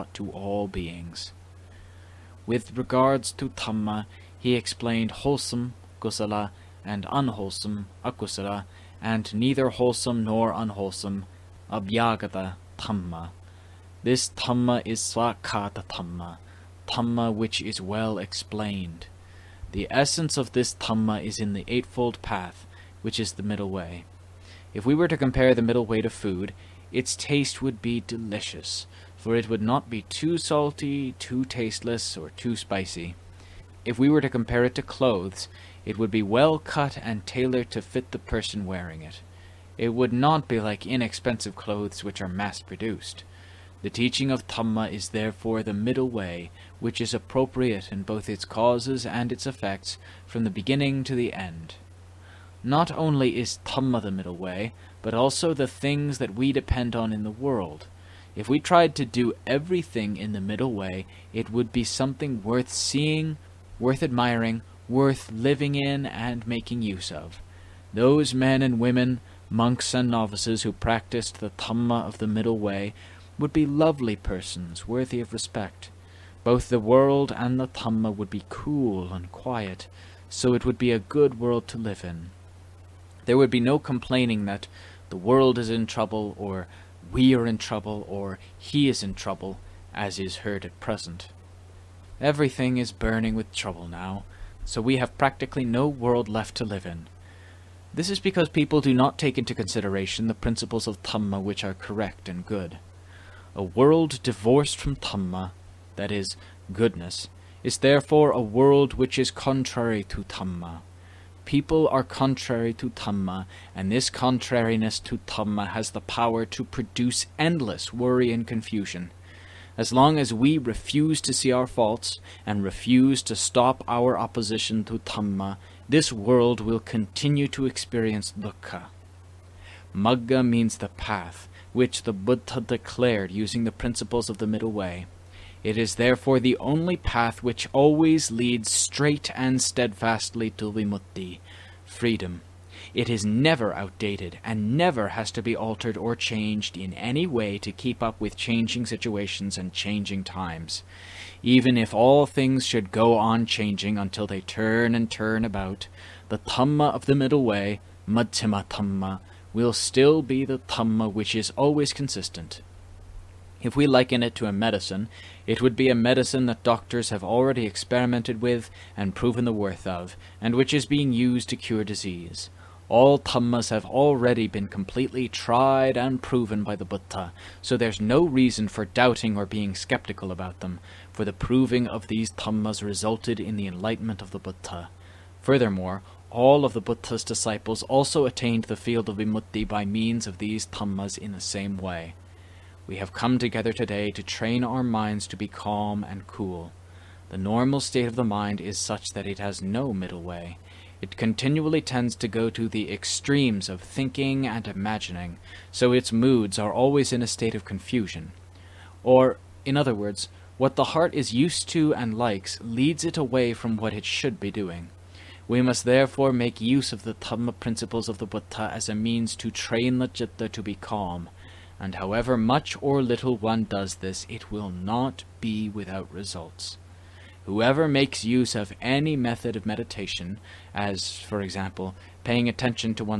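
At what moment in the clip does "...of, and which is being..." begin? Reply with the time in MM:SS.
02:49.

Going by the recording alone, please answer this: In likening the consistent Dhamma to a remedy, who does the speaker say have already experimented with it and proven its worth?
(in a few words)
doctors.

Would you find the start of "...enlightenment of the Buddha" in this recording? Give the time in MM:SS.
03:03.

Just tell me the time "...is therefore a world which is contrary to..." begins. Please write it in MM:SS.
01:47.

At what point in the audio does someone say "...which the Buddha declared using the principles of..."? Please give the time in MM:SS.
02:11.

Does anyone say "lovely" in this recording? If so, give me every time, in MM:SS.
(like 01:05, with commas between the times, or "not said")
01:13.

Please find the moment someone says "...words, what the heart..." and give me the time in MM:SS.
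03:29.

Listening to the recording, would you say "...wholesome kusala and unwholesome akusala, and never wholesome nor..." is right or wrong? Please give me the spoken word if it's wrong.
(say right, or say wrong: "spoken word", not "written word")
wrong: "neither", not "never".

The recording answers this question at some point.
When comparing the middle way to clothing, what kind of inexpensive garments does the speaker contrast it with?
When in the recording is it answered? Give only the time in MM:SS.
00:42.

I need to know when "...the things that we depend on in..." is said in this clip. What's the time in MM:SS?
00:55.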